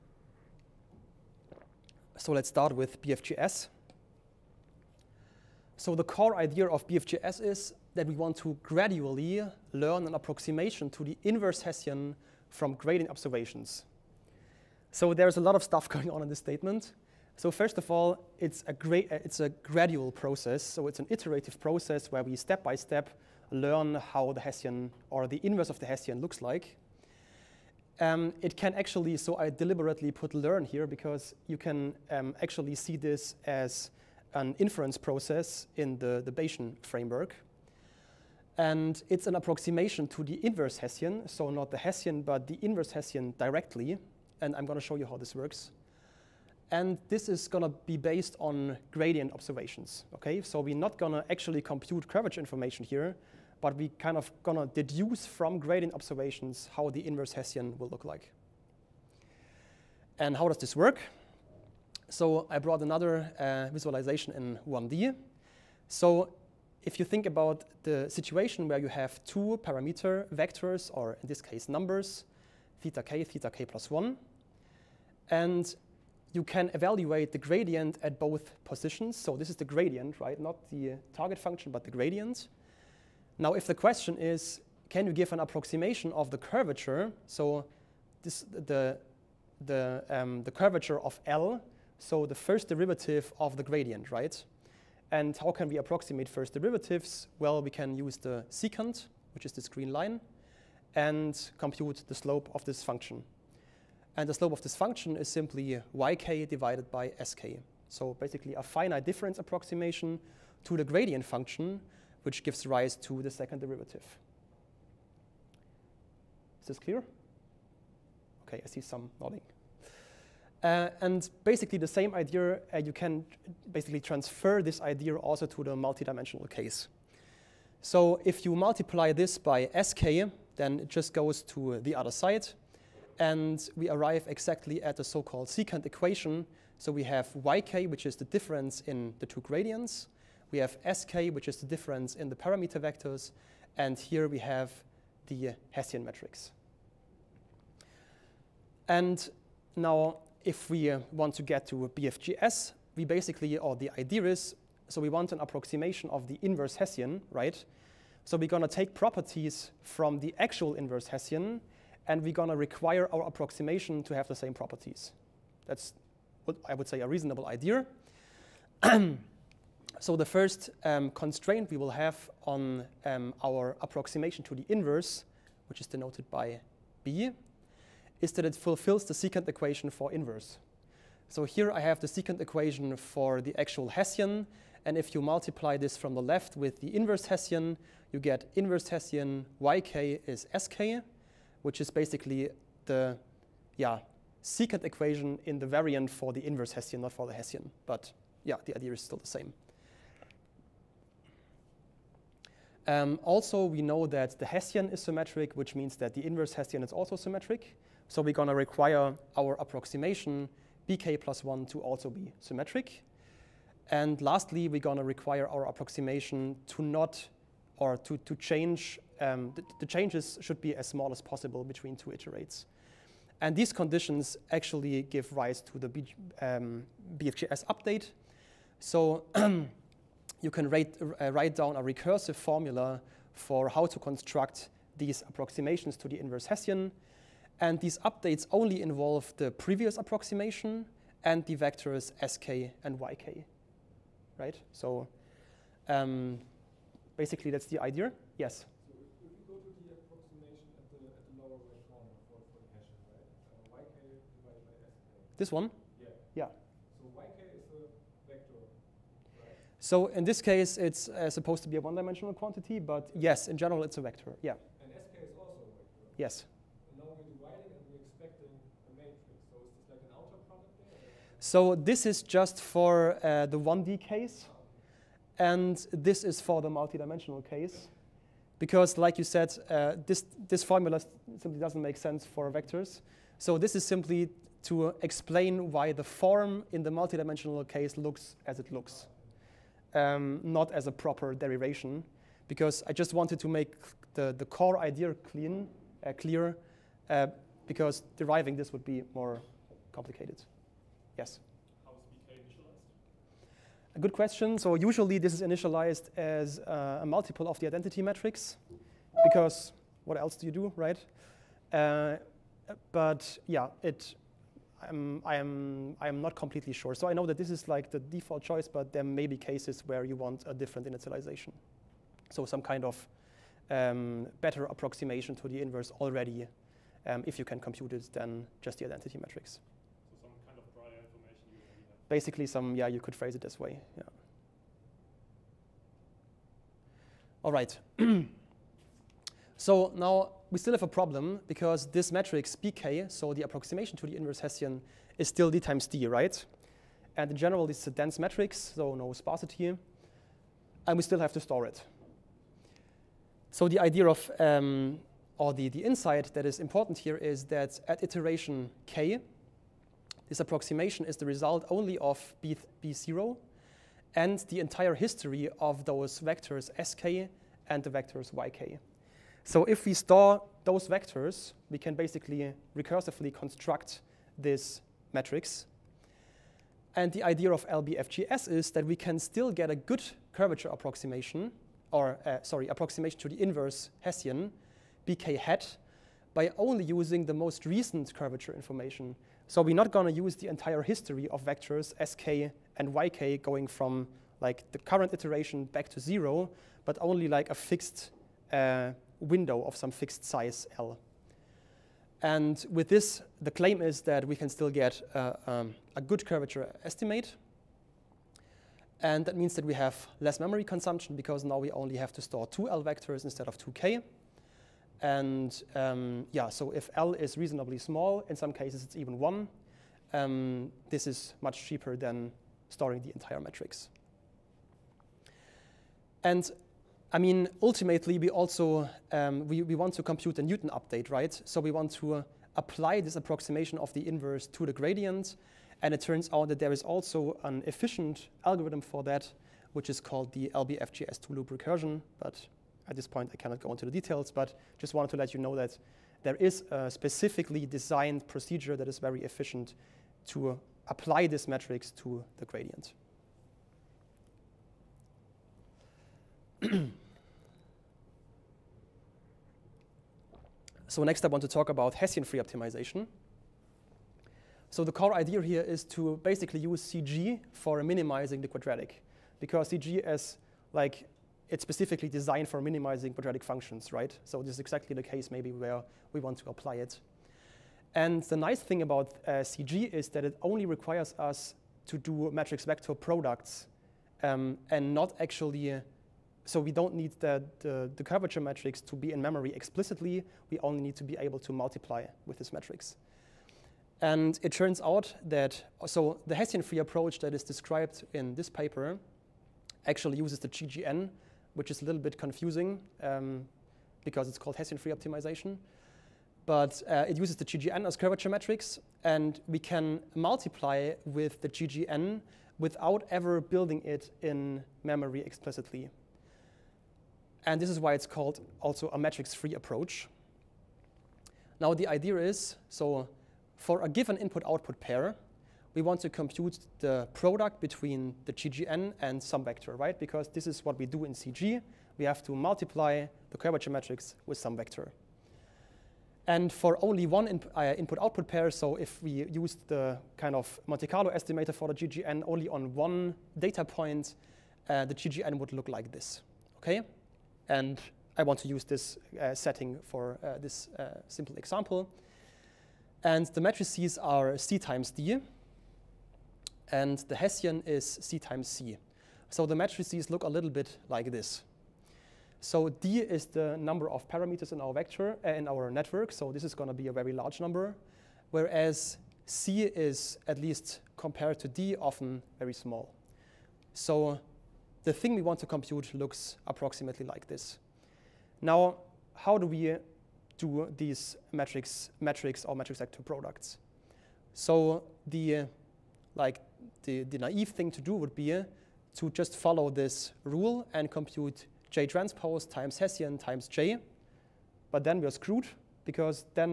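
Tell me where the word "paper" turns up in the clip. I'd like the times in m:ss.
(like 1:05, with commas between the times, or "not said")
8:18.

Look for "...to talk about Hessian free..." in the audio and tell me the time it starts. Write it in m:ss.
7:41.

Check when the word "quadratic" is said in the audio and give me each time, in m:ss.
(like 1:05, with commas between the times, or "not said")
7:48, 7:53.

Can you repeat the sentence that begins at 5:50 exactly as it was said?
And we still have to store it.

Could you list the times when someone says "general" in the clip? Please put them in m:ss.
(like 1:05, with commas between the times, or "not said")
4:23, 5:47.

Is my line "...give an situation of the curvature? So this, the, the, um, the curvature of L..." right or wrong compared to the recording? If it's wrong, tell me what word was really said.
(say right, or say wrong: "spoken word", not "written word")
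wrong: "approximation", not "situation".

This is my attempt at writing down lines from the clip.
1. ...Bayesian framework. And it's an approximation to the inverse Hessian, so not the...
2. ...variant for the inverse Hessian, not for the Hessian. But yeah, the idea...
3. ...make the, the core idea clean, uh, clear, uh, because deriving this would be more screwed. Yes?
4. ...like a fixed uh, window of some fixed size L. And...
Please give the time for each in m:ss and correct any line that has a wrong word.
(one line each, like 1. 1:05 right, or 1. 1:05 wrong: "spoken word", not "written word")
1. 0:36 right
2. 3:15 right
3. 4:53 wrong: "complicated", not "screwed"
4. 6:37 right.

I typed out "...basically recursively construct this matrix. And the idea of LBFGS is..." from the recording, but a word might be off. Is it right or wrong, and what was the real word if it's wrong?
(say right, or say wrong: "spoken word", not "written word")
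right.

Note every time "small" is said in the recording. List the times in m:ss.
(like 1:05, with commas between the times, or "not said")
3:40, 6:57, 9:32.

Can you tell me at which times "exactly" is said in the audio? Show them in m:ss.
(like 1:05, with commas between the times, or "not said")
2:14, 7:54.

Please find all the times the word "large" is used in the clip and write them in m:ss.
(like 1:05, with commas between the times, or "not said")
9:27.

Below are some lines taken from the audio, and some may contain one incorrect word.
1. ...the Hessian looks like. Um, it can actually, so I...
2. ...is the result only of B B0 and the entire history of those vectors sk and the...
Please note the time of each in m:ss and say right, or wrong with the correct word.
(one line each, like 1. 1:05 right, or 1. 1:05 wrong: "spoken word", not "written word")
1. 0:25 right
2. 6:01 right.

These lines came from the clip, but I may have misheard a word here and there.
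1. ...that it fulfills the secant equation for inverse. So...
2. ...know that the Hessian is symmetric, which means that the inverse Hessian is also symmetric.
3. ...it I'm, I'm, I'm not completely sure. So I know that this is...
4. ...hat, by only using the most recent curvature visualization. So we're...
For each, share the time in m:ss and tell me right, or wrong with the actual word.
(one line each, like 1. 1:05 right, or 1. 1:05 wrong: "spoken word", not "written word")
1. 2:58 right
2. 3:23 right
3. 5:13 right
4. 6:25 wrong: "information", not "visualization".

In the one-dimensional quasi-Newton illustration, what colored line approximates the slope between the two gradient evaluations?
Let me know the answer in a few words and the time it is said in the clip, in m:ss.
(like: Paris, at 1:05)
green line, at 1:39.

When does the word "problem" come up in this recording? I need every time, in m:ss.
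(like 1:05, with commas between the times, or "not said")
5:40.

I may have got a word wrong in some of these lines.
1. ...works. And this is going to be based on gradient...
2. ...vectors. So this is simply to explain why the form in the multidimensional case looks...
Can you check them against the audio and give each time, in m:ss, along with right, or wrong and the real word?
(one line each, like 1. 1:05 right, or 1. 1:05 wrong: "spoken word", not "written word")
1. 0:45 right
2. 4:42 right.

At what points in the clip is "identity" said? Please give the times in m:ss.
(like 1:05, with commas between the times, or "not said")
5:07, 5:28.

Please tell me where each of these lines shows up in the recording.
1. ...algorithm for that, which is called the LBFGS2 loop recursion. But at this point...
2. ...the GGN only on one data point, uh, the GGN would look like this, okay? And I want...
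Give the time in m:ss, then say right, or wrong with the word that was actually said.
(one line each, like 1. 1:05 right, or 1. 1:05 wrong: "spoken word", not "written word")
1. 7:18 right
2. 9:01 right.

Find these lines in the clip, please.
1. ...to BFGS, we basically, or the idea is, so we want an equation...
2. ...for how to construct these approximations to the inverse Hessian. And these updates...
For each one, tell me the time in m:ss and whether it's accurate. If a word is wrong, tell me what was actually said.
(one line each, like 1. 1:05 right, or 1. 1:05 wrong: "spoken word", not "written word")
1. 2:31 wrong: "approximation", not "equation"
2. 3:53 right.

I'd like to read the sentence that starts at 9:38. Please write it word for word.
Now, how do we do these matrix, matrix or matrix vector products?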